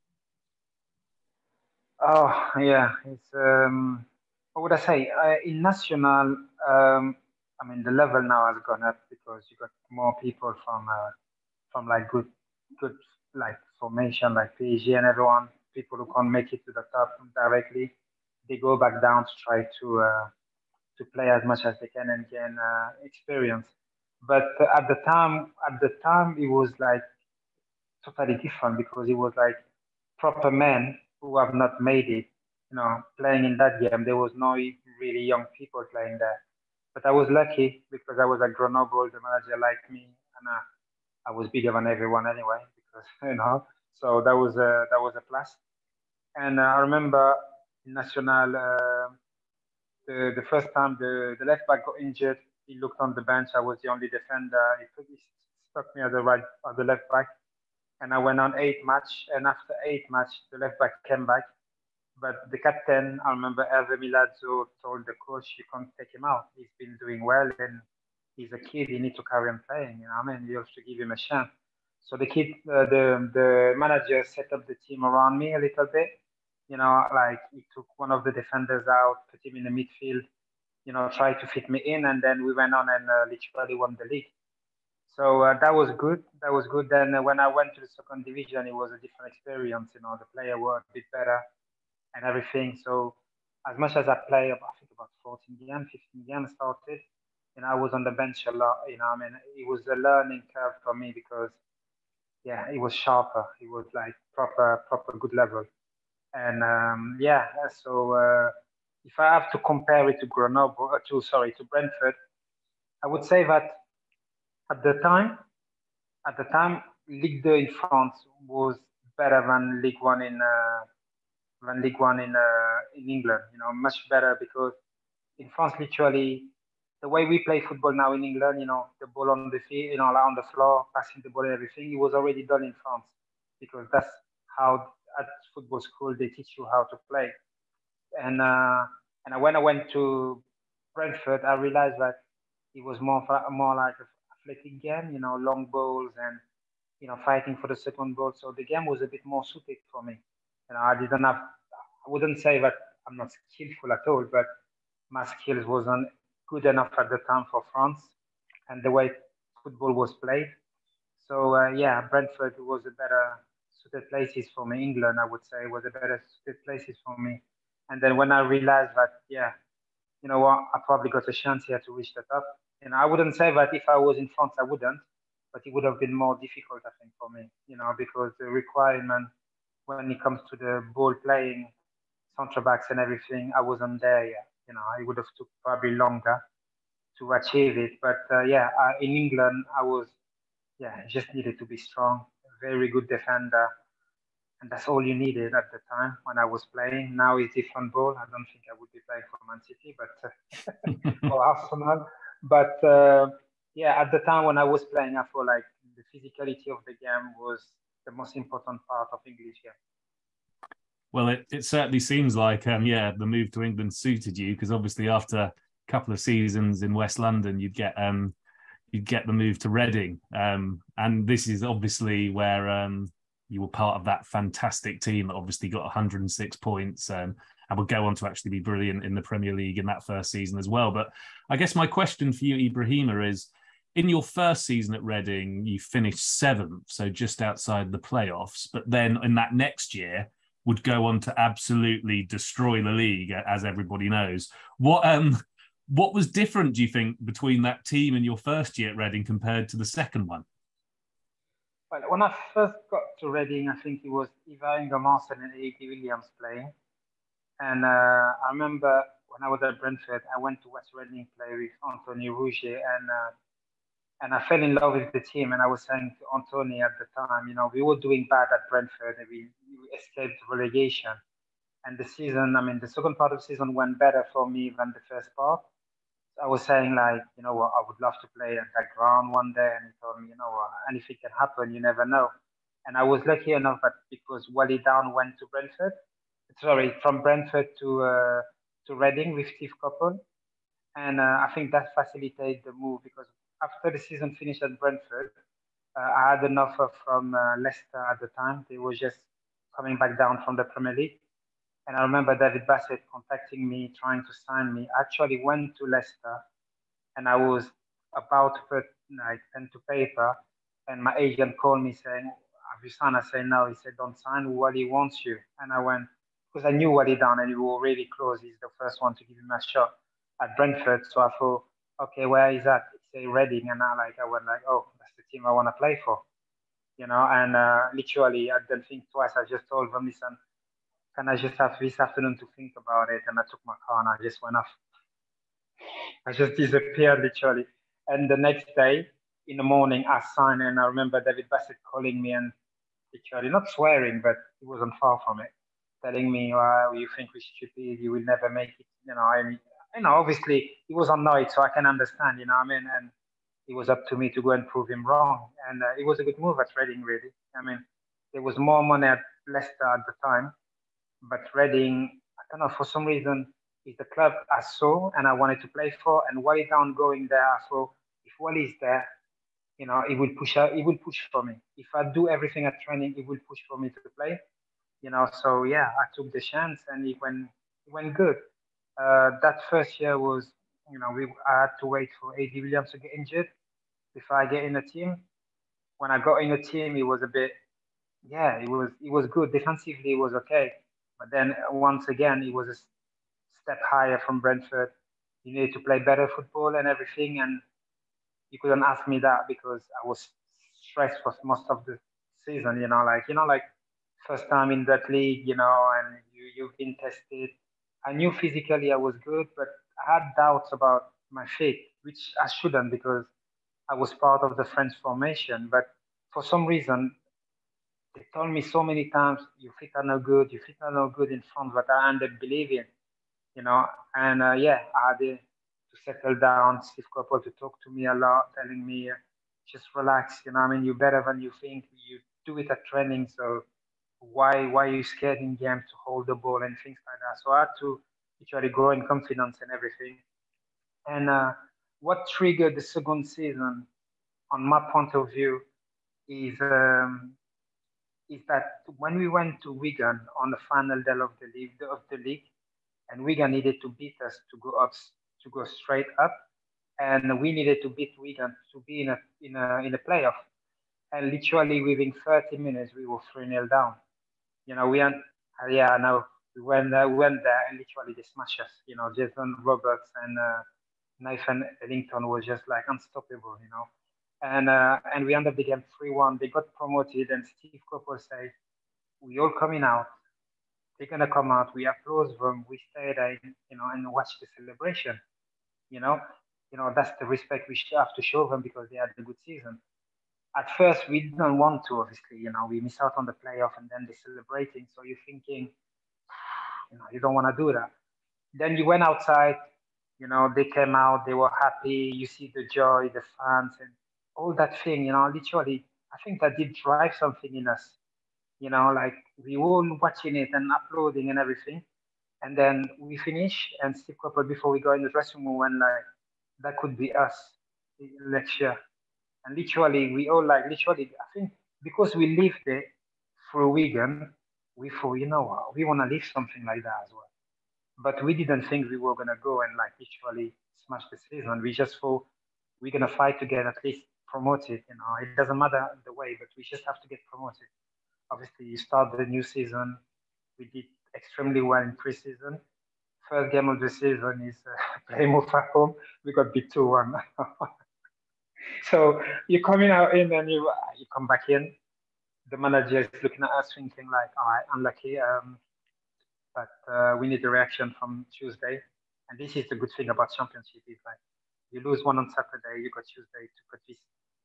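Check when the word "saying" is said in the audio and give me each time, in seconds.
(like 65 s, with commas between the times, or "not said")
265 s, 276 s, 311 s.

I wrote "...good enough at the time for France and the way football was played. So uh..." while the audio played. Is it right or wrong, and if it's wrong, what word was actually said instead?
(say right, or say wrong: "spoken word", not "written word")
right.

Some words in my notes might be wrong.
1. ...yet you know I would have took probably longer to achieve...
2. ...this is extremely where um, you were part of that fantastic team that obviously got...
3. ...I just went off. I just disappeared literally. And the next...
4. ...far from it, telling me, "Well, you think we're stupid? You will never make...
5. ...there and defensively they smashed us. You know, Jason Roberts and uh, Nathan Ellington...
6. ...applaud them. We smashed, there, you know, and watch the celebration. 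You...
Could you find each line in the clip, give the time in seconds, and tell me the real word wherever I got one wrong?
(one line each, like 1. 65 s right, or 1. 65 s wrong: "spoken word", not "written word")
1. 184 s right
2. 221 s wrong: "obviously", not "extremely"
3. 334 s right
4. 345 s right
5. 467 s wrong: "literally", not "defensively"
6. 481 s wrong: "stayed", not "smashed".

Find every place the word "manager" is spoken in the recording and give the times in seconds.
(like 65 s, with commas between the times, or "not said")
39 s, 73 s, 552 s.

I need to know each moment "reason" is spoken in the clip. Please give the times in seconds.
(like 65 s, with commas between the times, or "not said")
363 s, 416 s.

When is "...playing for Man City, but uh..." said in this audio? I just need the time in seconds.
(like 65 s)
199 s.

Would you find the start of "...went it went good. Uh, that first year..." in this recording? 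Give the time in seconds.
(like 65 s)
377 s.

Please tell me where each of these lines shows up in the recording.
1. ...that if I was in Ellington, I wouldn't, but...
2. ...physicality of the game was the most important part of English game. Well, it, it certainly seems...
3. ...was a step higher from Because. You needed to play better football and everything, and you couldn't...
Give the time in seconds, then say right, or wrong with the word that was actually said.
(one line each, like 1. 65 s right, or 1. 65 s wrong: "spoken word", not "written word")
1. 173 s wrong: "France", not "Ellington"
2. 206 s right
3. 392 s wrong: "Brentford", not "Because".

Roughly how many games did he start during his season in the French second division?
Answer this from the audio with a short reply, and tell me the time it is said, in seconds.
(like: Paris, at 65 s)
14, at 95 s.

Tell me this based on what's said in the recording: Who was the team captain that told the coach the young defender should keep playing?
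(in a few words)
Hervé Milazzo.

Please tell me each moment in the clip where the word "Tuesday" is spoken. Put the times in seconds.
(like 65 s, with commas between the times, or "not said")
558 s, 563 s.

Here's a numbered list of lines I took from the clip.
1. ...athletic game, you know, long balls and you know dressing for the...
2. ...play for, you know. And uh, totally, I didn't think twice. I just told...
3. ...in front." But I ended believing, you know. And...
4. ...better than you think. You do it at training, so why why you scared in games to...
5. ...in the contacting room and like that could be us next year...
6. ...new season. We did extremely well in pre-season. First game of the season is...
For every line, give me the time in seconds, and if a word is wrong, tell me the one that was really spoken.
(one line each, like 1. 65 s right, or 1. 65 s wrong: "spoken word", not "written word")
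1. 144 s wrong: "fighting", not "dressing"
2. 325 s wrong: "literally", not "totally"
3. 421 s right
4. 431 s right
5. 514 s wrong: "dressing", not "contacting"
6. 539 s right.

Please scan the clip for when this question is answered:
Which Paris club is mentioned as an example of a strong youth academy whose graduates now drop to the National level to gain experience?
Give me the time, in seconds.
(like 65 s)
14 s.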